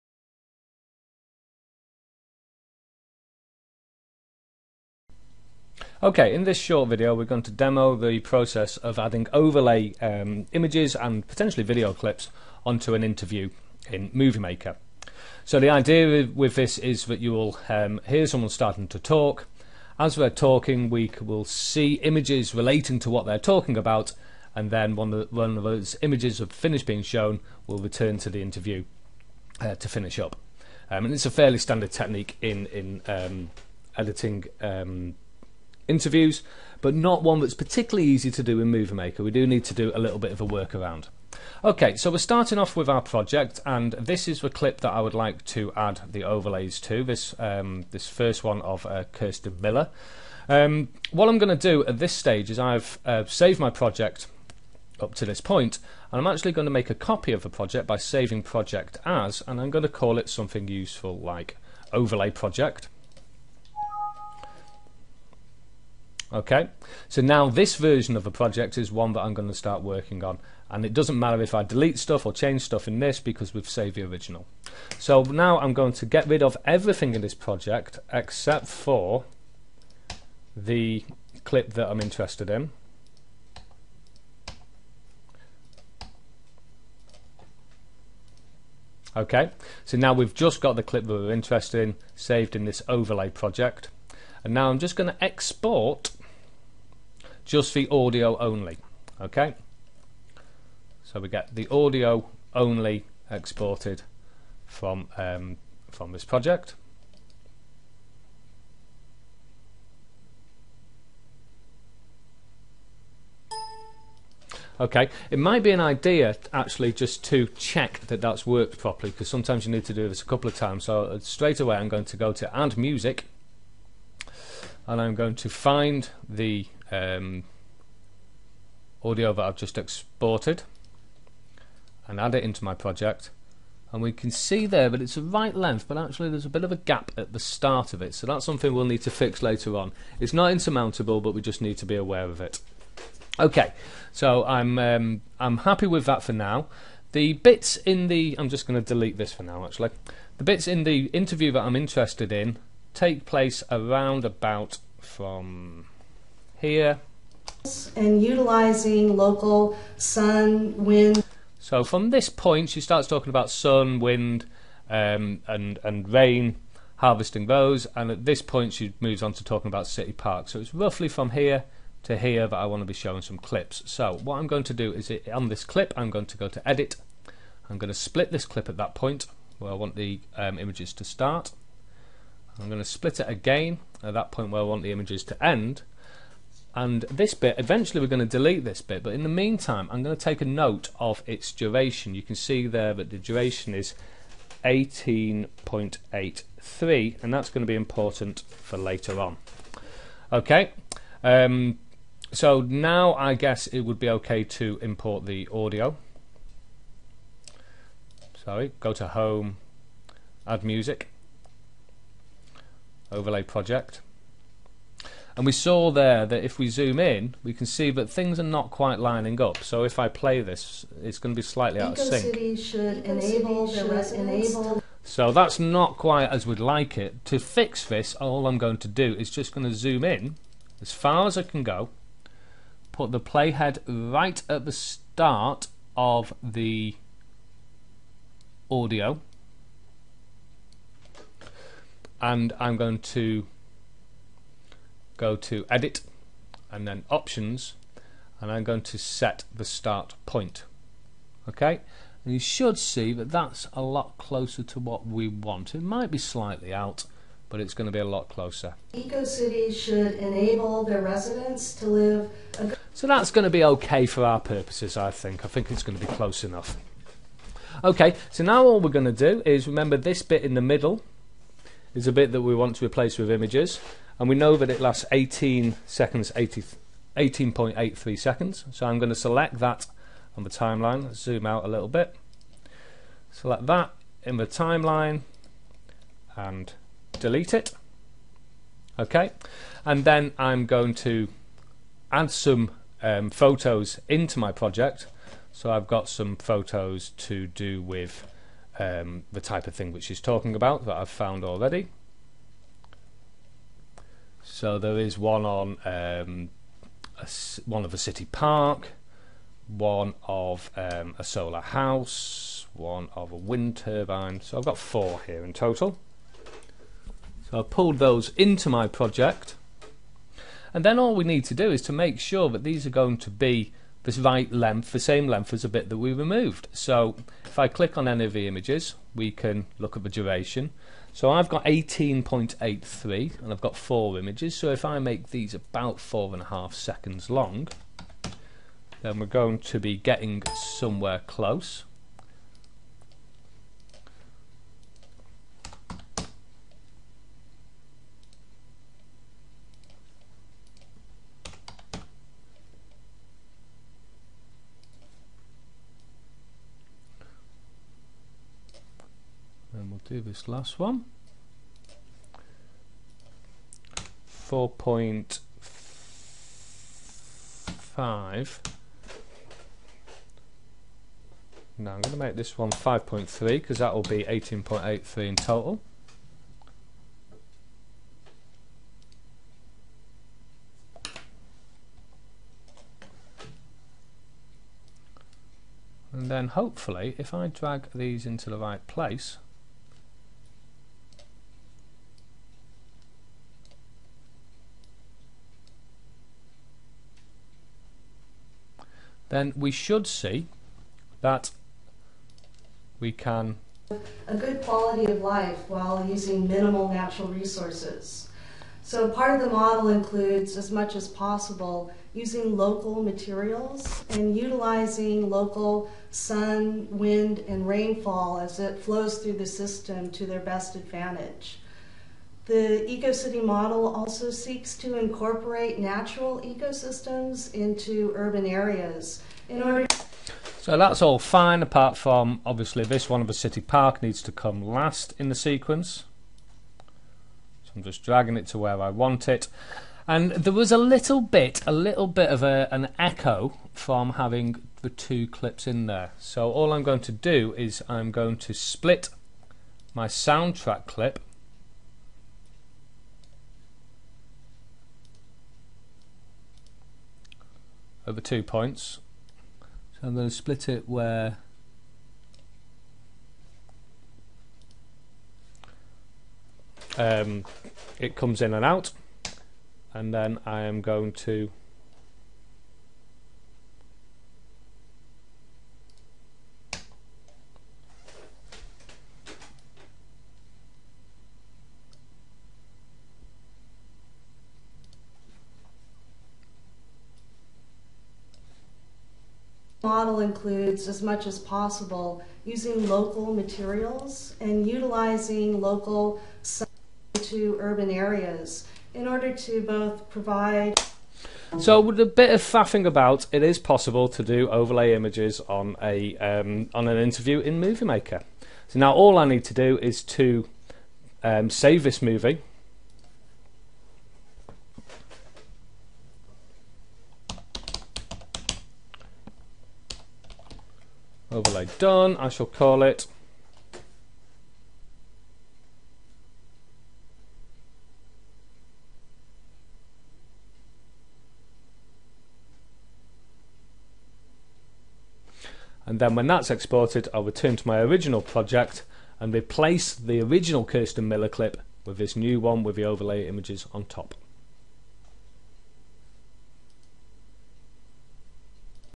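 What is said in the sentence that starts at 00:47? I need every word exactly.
This um, this first one of uh, Kirsten Miller.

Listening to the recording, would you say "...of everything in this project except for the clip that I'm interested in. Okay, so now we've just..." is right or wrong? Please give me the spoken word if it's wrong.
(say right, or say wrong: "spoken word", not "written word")
right.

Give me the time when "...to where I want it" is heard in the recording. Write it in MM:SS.
07:18.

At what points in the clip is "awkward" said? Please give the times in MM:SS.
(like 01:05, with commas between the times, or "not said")
not said.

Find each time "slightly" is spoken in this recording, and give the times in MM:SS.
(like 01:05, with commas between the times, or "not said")
03:41, 04:16.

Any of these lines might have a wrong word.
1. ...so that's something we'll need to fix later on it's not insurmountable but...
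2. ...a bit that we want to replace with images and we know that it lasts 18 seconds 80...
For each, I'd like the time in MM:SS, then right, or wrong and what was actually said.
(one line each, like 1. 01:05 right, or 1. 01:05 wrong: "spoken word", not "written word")
1. 02:18 right
2. 04:32 right.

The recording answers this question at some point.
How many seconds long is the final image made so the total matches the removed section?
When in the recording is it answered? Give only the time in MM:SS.
06:12.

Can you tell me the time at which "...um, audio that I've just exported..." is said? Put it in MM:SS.
02:06.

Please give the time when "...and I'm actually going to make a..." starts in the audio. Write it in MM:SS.
00:56.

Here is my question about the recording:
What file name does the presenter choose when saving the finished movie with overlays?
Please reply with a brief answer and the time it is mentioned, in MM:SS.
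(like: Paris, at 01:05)
Overlay done, at 08:41.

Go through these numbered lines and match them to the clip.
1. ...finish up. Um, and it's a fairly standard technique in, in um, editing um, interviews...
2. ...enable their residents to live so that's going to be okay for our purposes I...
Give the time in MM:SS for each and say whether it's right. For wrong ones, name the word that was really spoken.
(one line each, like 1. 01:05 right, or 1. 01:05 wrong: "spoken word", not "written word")
1. 00:29 right
2. 04:20 right.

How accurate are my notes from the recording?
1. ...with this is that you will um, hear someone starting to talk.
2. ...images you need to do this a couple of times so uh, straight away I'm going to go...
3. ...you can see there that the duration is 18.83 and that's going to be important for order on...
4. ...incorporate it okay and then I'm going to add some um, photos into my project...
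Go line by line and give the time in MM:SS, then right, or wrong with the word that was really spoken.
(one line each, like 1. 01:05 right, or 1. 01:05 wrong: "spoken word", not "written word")
1. 00:16 right
2. 01:59 wrong: "sometimes", not "images"
3. 03:12 wrong: "later", not "order"
4. 04:47 wrong: "delete", not "incorporate".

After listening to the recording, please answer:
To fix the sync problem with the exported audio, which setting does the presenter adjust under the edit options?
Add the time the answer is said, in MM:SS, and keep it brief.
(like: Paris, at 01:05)
start point, at 04:09.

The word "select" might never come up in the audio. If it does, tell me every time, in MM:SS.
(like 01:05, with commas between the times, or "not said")
04:39, 04:43.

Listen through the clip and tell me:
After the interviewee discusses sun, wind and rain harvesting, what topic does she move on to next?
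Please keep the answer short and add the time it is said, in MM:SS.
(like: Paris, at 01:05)
city parks, at 02:49.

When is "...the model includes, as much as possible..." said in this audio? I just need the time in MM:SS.
06:49.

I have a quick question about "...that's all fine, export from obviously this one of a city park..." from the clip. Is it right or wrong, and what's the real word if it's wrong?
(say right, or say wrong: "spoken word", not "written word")
wrong: "apart", not "export".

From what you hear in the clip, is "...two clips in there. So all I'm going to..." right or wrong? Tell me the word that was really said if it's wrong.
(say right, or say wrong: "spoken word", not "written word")
right.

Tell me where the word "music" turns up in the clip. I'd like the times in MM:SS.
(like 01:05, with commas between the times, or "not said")
02:02, 03:30.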